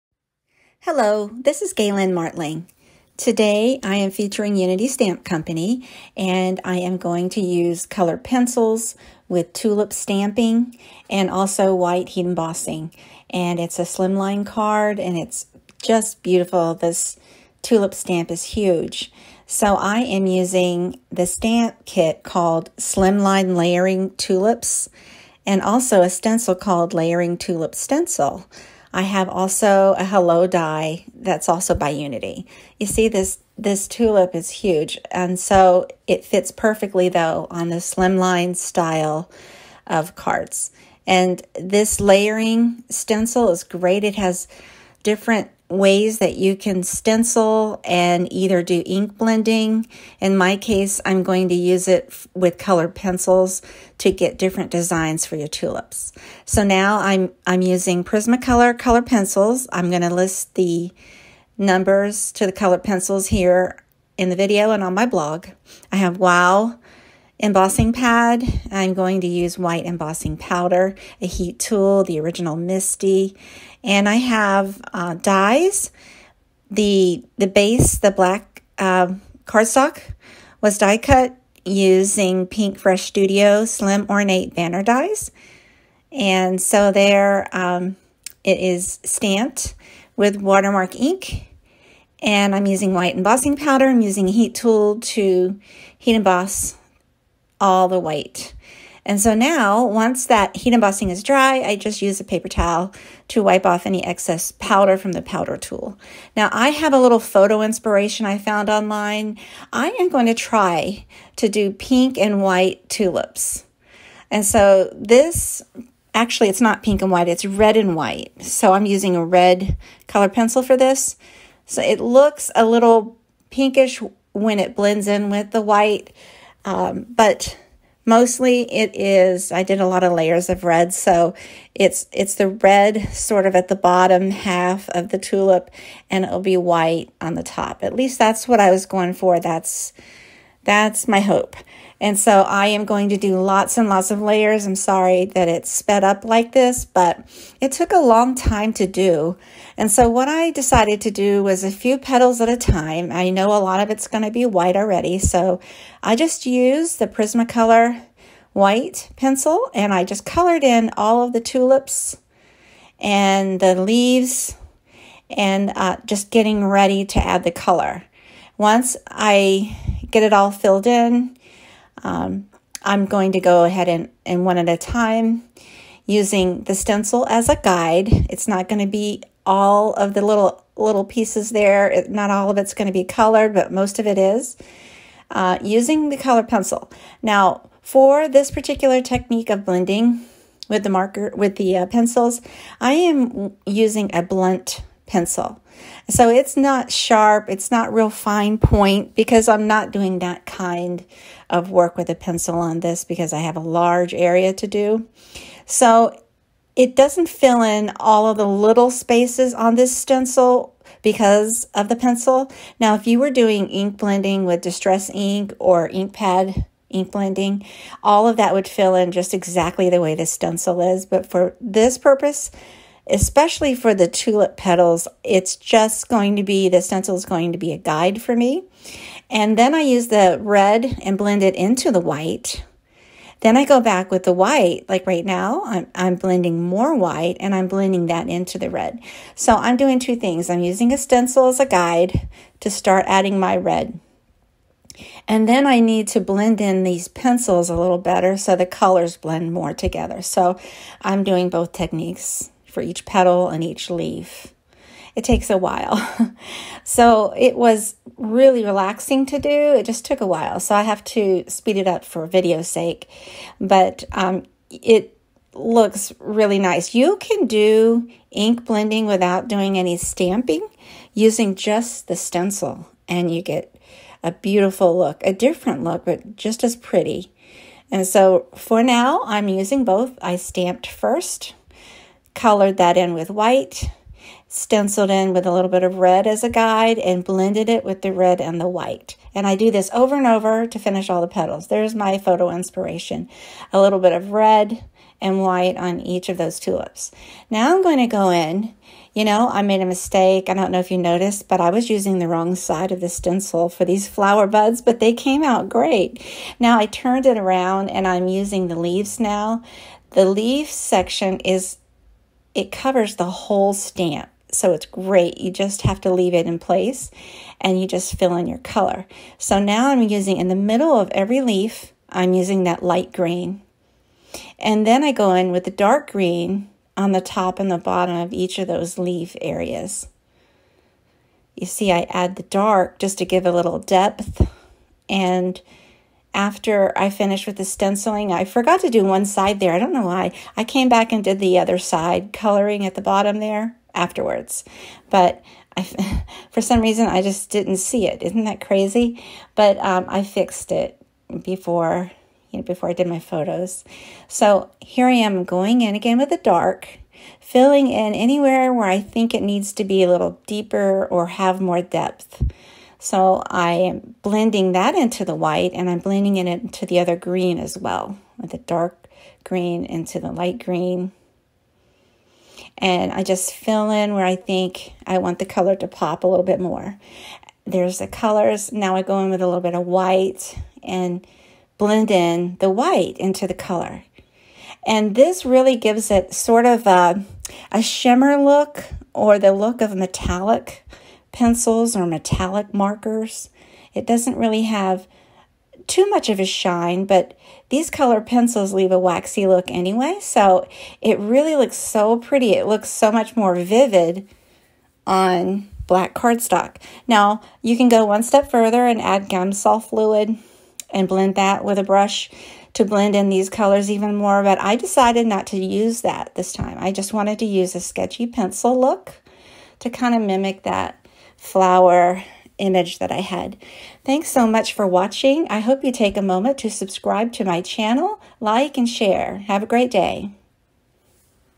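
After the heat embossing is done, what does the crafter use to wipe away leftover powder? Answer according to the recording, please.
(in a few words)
a paper towel.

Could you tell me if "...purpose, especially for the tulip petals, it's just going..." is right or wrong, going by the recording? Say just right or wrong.
right.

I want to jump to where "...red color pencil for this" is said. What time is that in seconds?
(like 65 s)
119 s.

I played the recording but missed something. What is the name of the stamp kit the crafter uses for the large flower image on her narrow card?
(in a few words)
Slimline Layering Tulips.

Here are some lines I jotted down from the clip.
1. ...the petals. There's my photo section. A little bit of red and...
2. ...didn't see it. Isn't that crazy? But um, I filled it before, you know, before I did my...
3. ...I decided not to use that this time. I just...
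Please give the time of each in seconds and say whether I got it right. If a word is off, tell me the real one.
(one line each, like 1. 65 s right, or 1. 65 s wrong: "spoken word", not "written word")
1. 291 s wrong: "inspiration", not "section"
2. 347 s wrong: "fixed", not "filled"
3. 414 s right.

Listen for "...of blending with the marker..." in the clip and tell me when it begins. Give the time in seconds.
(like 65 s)
189 s.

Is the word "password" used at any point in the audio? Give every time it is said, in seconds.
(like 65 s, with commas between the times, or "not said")
not said.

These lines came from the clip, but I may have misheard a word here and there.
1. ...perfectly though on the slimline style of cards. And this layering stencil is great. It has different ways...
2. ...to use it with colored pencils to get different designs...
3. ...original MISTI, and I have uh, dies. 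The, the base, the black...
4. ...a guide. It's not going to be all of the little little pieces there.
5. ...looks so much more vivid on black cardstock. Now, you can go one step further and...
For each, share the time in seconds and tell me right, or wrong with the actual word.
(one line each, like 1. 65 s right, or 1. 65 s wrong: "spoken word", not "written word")
1. 36 s right
2. 51 s right
3. 72 s right
4. 177 s right
5. 402 s right.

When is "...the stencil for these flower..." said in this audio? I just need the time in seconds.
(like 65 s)
303 s.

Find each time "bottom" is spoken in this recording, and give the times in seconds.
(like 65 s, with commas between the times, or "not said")
133 s, 327 s, 343 s.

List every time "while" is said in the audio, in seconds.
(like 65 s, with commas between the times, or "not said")
255 s, 260 s.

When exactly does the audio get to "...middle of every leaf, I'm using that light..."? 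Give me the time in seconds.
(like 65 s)
320 s.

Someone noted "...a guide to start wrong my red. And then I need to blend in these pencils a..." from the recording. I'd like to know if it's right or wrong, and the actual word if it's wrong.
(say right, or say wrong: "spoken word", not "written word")
wrong: "adding", not "wrong".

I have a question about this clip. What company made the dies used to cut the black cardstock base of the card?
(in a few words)
Pink Fresh Studio.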